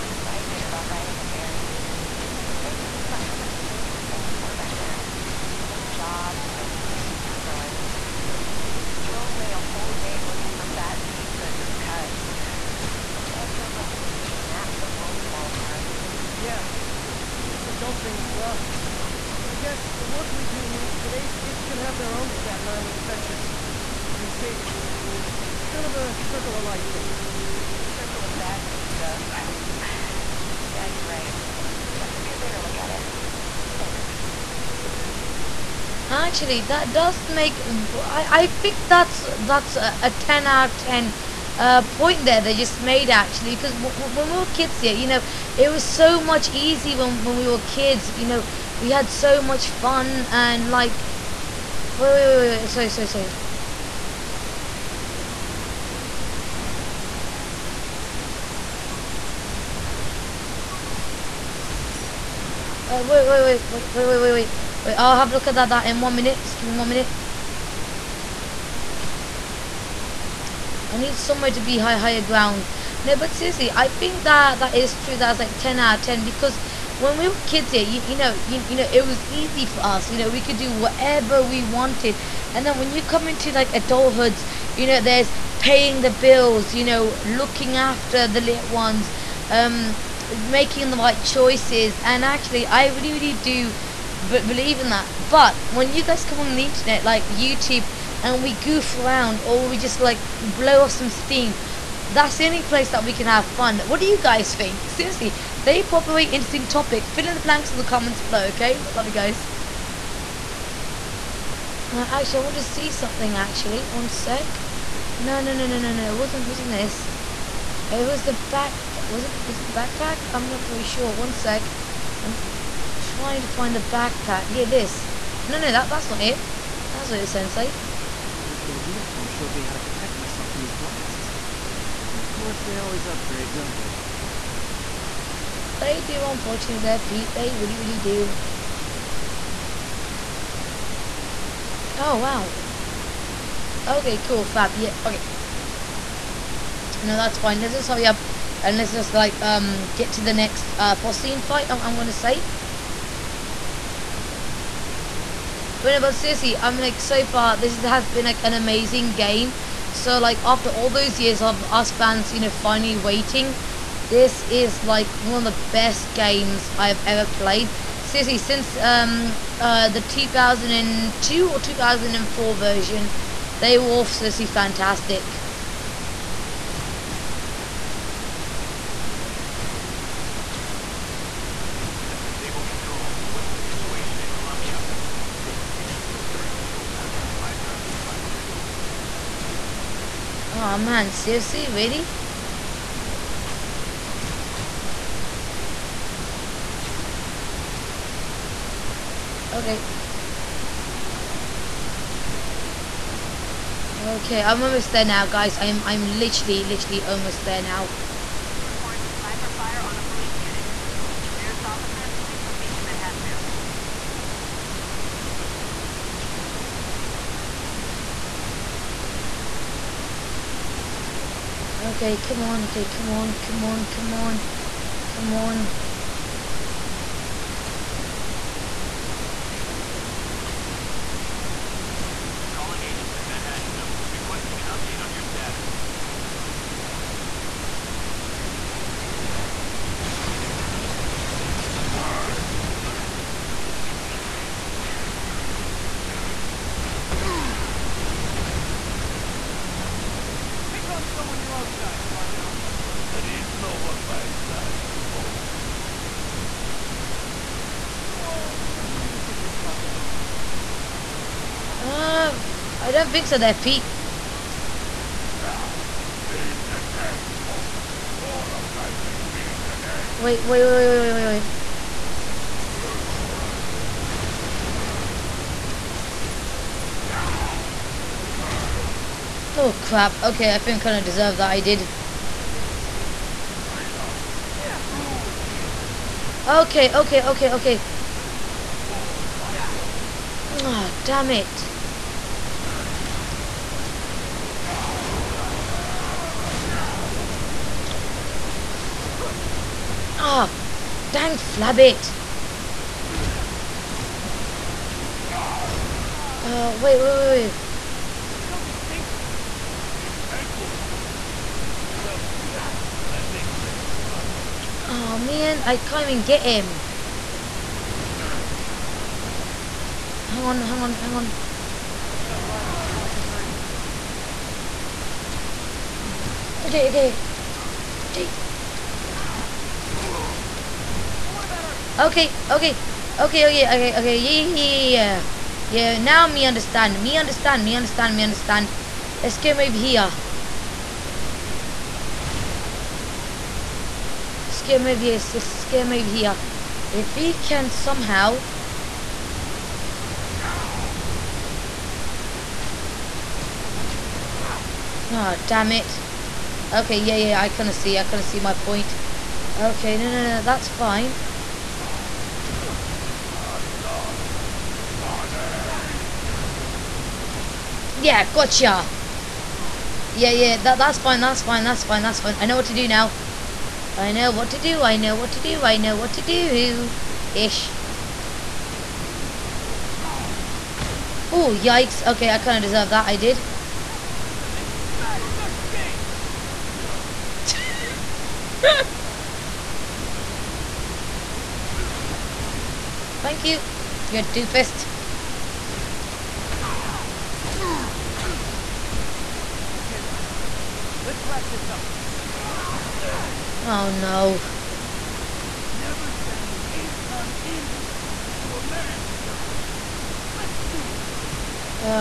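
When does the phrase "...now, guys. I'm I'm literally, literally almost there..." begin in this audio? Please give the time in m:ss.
3:25.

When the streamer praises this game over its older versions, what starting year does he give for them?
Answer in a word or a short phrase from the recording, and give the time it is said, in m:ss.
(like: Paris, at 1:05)
2002, at 2:49.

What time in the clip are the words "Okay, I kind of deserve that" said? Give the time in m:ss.
6:22.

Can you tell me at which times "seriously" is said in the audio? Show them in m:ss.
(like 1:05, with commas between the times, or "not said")
1:13, 1:44, 2:36, 2:47, 2:54, 3:11.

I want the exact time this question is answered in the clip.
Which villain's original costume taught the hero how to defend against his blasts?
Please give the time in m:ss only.
2:07.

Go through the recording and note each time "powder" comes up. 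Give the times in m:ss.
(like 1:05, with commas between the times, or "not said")
not said.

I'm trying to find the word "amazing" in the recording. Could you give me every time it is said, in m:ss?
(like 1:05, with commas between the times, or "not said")
2:38.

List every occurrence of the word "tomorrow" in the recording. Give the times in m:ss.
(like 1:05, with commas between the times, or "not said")
not said.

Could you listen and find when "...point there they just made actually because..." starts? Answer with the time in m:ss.
0:41.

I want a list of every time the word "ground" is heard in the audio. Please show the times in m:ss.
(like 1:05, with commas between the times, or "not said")
1:12.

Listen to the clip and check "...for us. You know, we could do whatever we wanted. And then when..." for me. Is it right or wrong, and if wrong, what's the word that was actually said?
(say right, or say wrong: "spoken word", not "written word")
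right.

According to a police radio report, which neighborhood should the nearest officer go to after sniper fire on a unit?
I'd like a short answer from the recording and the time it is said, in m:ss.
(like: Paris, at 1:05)
Manhattanville, at 3:32.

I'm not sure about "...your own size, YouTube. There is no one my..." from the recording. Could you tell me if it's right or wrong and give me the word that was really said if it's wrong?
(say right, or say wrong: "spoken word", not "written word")
wrong: "Rhino", not "YouTube".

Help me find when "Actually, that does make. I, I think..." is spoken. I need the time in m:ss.
0:36.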